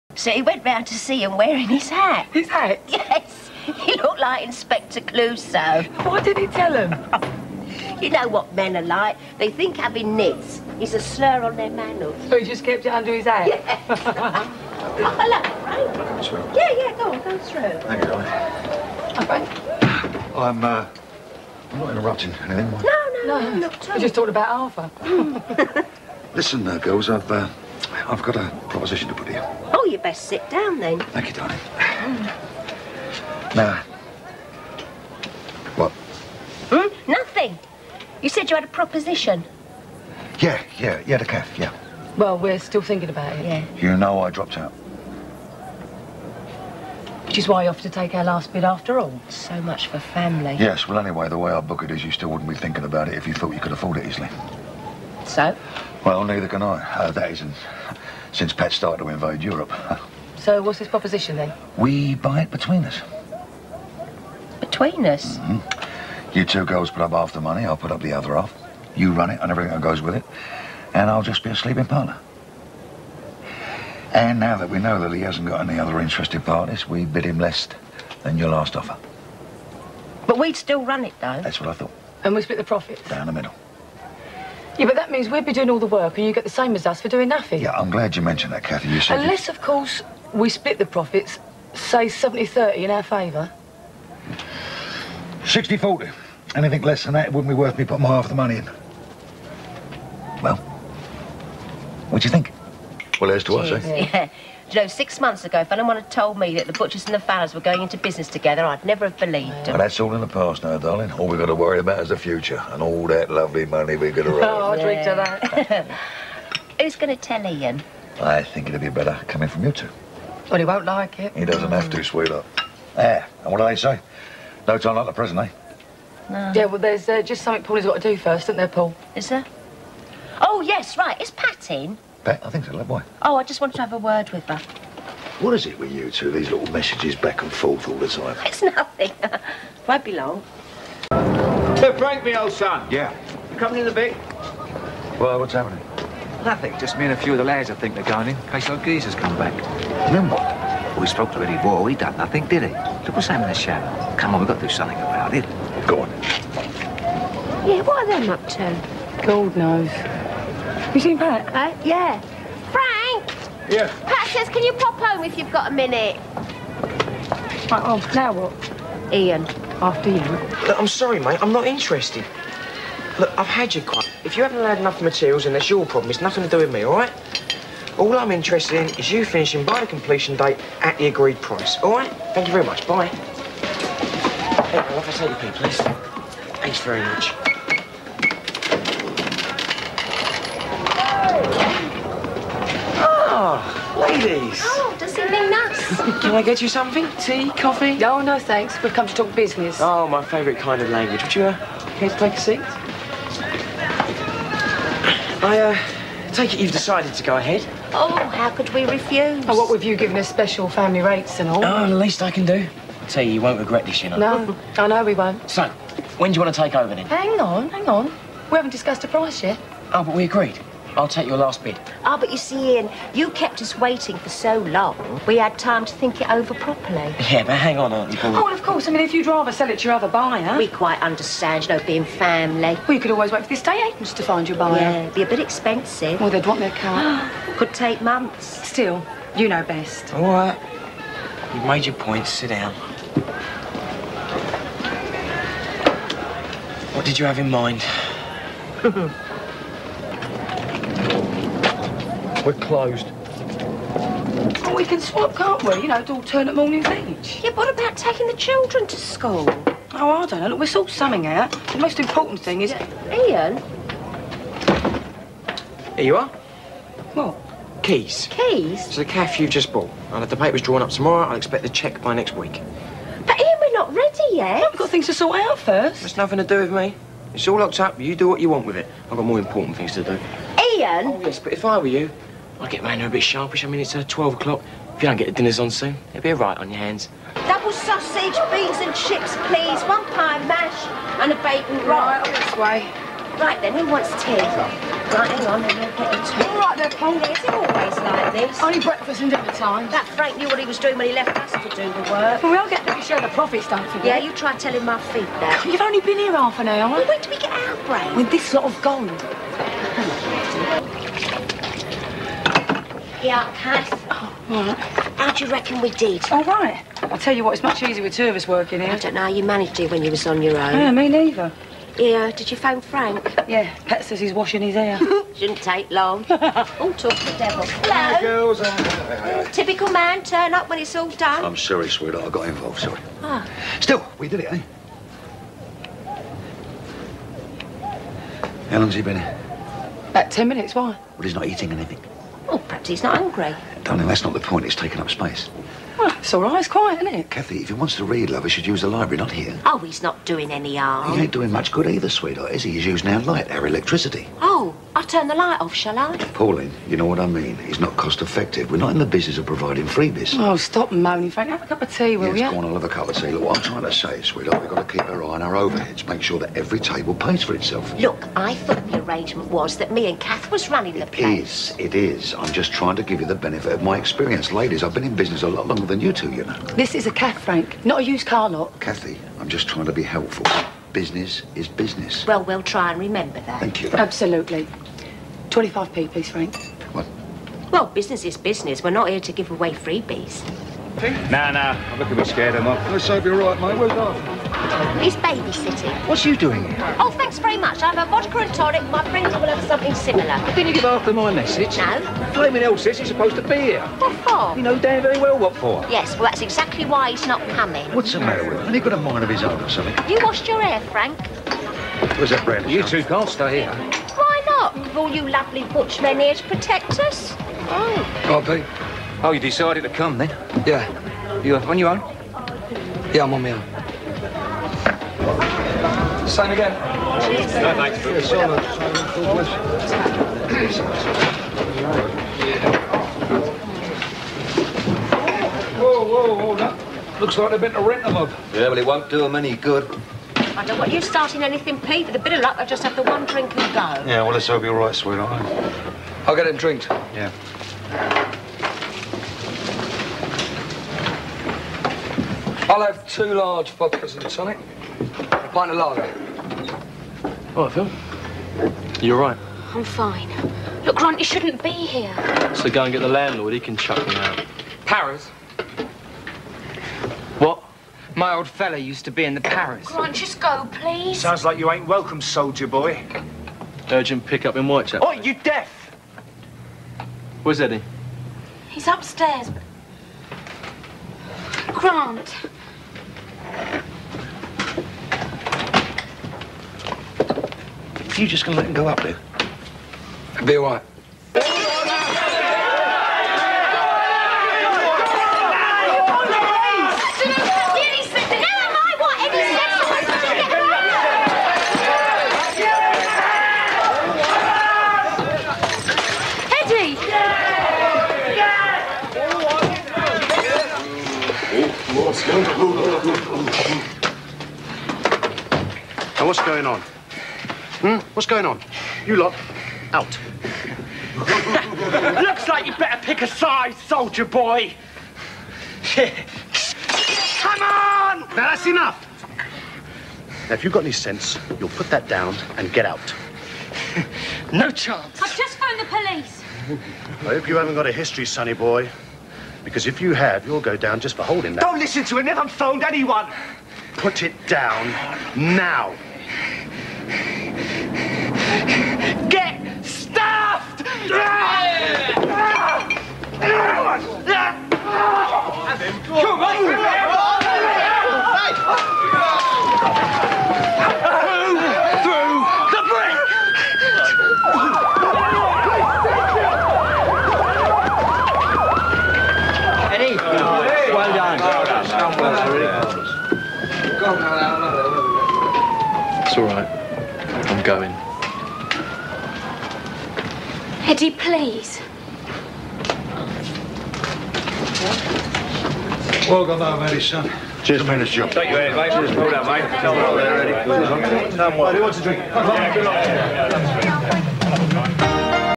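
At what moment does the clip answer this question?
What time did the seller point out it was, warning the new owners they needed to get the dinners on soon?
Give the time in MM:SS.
04:44.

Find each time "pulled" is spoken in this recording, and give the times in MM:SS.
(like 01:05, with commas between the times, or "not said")
09:49.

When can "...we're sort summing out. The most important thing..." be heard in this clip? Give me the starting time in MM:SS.
04:20.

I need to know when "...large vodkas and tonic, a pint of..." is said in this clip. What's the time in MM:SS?
07:33.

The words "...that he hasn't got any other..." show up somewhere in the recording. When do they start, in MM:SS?
01:15.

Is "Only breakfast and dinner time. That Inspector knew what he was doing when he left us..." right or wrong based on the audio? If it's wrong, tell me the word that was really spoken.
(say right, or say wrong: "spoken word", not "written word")
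wrong: "Frank", not "Inspector".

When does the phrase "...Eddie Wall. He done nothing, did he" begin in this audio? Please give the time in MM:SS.
02:31.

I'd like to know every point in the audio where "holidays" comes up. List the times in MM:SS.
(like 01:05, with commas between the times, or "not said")
not said.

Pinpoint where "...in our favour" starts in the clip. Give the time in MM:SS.
01:32.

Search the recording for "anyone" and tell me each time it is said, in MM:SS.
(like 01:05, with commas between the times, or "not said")
01:45, 09:02.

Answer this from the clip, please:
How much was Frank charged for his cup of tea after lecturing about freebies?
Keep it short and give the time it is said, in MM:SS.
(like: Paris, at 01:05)
25p, at 06:25.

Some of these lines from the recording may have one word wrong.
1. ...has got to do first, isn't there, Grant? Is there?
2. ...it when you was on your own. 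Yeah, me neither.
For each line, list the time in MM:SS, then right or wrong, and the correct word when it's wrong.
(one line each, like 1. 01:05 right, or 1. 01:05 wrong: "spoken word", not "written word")
1. 02:07 wrong: "Paul", not "Grant"
2. 05:19 right.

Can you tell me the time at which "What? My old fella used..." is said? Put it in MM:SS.
07:47.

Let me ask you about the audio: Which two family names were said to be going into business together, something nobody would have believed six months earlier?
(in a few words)
The Butchers and the Fowlers.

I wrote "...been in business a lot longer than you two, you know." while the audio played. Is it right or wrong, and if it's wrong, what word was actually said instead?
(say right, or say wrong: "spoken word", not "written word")
right.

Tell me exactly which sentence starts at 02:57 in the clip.
All I'm interested in is you finishing by the completion date at the agreed price, all right?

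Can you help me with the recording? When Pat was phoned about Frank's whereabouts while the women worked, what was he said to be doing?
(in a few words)
Washing his hair.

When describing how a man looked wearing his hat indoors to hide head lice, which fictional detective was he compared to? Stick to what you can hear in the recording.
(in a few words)
Inspector Clouseau.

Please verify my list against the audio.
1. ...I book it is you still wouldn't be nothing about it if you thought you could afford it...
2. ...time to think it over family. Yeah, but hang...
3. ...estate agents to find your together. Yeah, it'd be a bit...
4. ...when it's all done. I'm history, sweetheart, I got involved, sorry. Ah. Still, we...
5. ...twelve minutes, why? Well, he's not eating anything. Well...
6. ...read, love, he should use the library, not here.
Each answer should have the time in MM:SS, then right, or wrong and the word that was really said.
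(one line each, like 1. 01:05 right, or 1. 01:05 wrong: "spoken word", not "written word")
1. 00:51 wrong: "thinking", not "nothing"
2. 03:45 wrong: "properly", not "family"
3. 03:53 wrong: "buyer", not "together"
4. 05:30 wrong: "sorry", not "history"
5. 05:40 wrong: "ten", not "twelve"
6. 05:48 right.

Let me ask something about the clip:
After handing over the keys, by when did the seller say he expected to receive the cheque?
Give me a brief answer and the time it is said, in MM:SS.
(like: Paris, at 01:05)
Next week, at 04:32.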